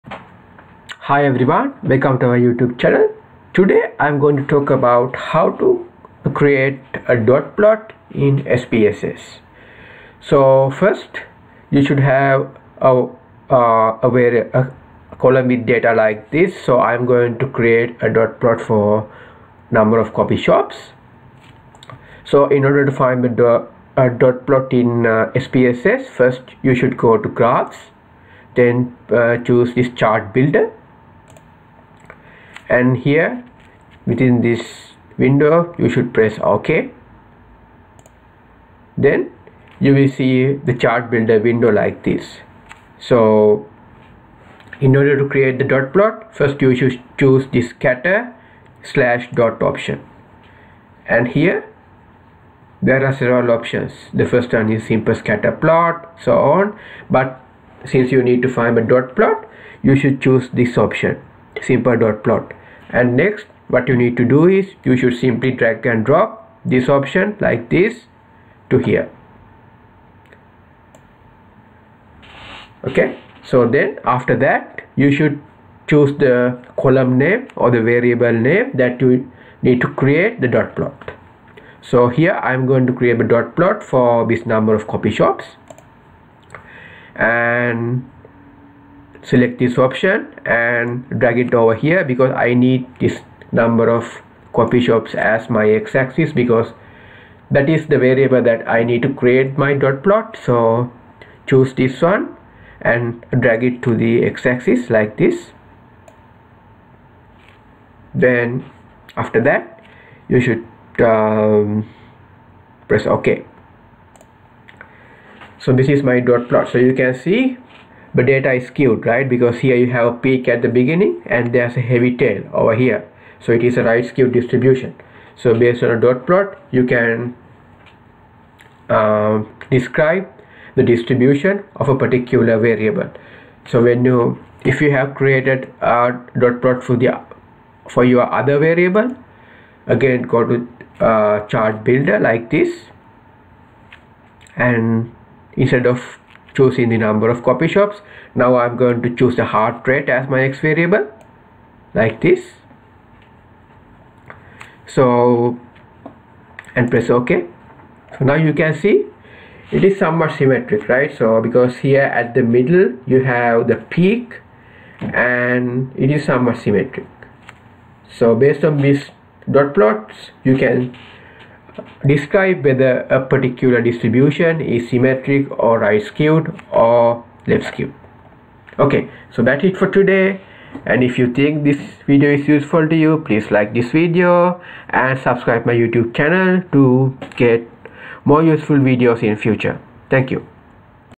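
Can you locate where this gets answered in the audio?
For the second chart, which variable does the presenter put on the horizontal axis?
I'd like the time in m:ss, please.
2:29.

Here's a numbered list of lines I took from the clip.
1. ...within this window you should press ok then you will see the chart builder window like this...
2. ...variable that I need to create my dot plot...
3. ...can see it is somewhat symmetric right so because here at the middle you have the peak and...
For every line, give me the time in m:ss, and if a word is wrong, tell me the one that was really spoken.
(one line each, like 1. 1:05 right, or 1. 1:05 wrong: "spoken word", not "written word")
1. 0:34 right
2. 1:37 right
3. 2:38 right.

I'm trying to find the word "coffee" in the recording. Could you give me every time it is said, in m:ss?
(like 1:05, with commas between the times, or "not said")
1:34.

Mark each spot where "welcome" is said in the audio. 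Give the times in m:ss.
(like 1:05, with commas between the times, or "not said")
0:01.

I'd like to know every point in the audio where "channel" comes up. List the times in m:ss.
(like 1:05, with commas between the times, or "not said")
0:02, 3:06.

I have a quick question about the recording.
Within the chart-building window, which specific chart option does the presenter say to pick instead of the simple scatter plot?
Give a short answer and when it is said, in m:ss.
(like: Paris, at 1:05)
Simple dot plot, at 1:01.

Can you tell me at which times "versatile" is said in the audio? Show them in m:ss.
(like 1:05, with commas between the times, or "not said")
not said.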